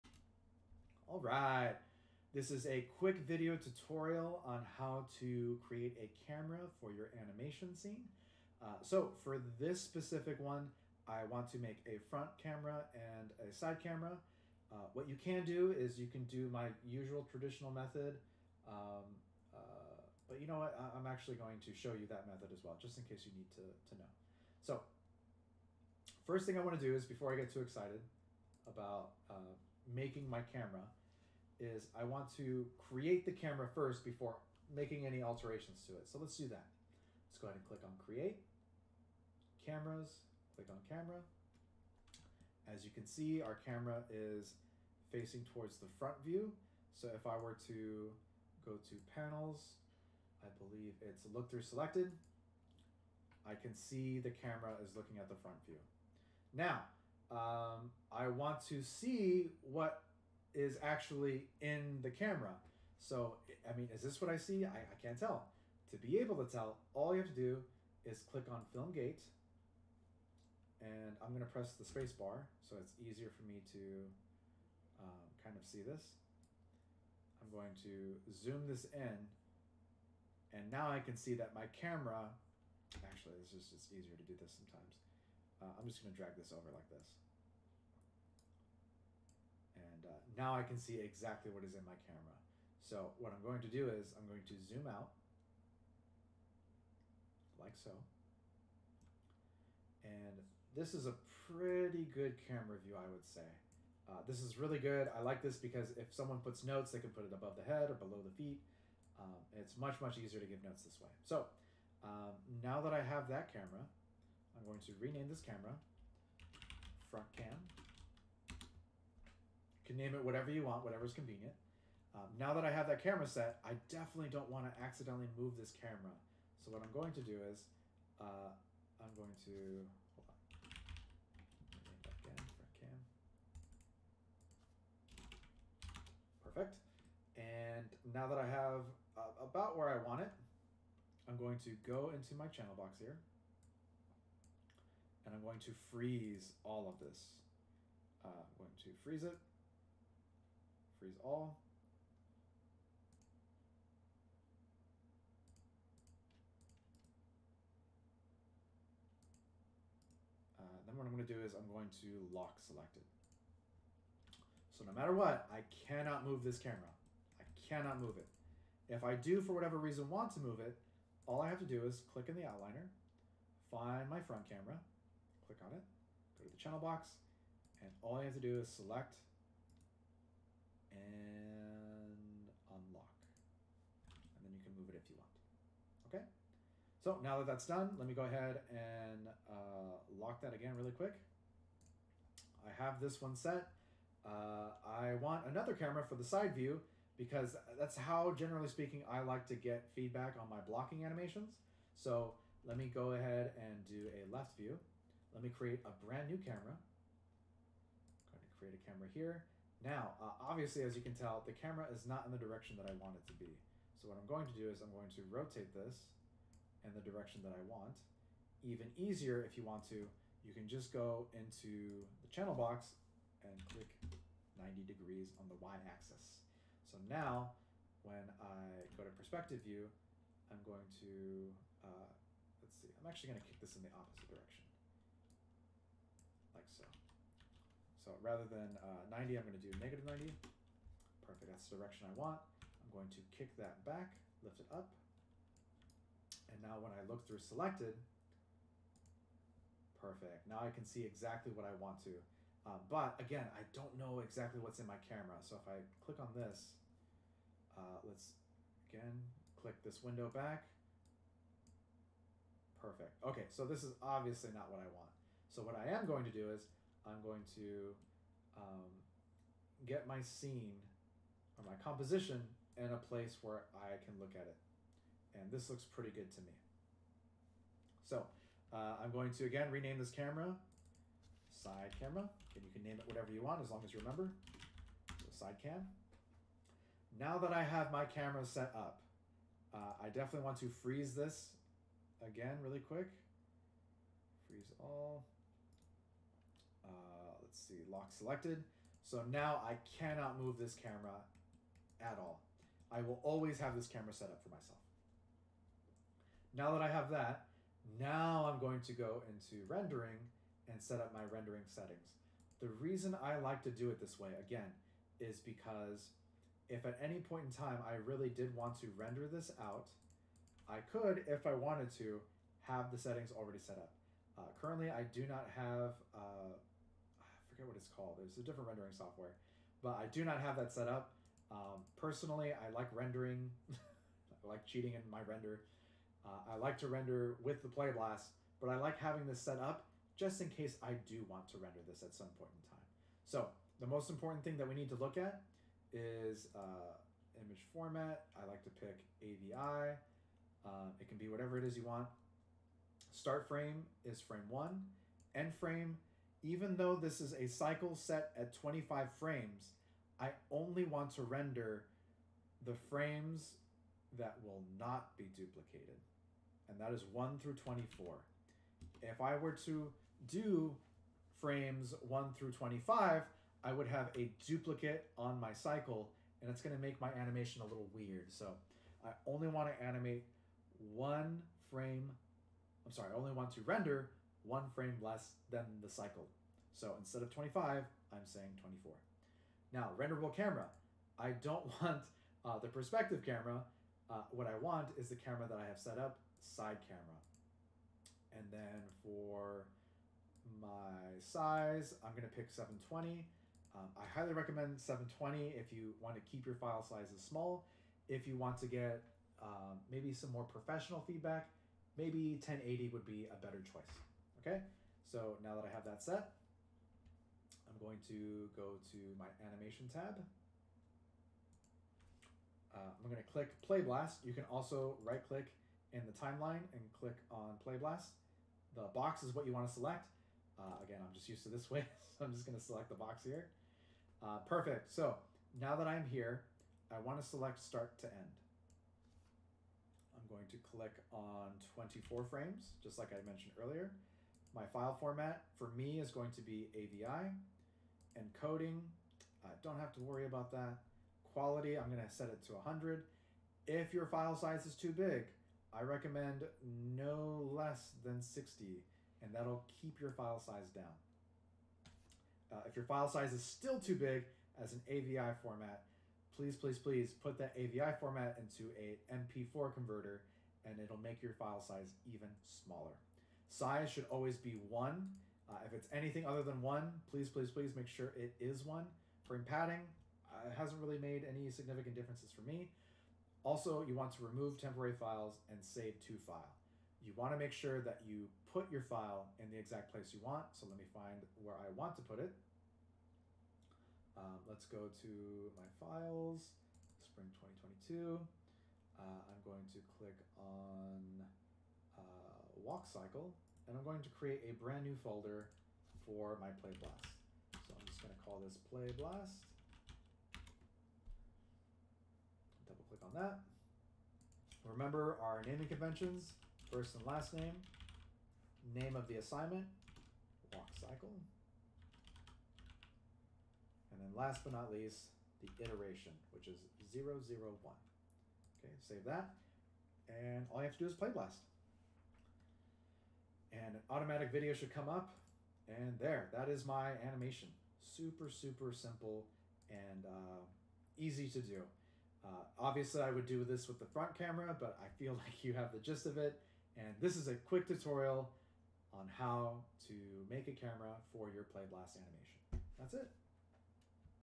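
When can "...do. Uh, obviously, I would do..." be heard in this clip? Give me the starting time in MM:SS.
09:01.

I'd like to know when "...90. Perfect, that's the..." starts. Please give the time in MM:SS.
04:00.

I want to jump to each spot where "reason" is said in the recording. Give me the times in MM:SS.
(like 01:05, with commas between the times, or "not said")
02:49, 05:12.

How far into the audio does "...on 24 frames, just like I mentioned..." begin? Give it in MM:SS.
07:21.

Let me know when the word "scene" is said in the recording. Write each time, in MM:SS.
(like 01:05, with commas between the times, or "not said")
00:07, 04:30.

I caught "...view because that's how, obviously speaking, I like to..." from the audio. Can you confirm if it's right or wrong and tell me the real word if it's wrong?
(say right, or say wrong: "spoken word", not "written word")
wrong: "generally", not "obviously".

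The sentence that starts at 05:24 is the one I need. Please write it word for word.
Uh, currently, I do not have uh, forget what it's called.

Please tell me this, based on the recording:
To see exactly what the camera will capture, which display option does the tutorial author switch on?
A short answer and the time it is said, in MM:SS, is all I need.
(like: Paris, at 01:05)
Film Gate, at 01:08.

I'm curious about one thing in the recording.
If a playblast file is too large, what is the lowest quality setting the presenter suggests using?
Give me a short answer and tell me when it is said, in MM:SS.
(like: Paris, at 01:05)
60, at 07:38.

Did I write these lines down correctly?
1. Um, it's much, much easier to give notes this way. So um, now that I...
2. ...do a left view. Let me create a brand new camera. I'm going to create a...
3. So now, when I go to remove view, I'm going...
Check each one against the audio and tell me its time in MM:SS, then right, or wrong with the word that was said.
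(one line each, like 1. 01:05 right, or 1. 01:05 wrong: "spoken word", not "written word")
1. 01:49 right
2. 03:23 right
3. 03:46 wrong: "perspective", not "remove".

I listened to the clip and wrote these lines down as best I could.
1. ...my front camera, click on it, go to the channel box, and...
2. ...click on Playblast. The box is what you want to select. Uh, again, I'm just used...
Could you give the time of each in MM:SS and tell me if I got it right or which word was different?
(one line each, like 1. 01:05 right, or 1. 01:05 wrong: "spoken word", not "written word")
1. 02:54 right
2. 07:06 right.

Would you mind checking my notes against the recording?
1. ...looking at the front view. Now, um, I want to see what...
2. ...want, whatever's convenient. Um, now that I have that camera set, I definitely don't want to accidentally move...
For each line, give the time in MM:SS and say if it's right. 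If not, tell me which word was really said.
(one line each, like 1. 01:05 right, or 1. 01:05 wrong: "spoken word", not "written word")
1. 00:54 right
2. 02:00 right.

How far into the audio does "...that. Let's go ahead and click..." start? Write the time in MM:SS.
00:36.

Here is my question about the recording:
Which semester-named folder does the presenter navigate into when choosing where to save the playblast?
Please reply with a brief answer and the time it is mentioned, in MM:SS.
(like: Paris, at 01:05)
spring 2022, at 08:17.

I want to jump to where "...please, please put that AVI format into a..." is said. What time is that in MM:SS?
07:46.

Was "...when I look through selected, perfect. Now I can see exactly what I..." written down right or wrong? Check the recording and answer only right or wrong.
right.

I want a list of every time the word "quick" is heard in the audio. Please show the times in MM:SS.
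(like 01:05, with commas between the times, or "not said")
00:02, 03:10, 04:52, 09:07.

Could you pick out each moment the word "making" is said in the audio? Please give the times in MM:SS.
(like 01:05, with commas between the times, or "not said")
00:29, 00:34.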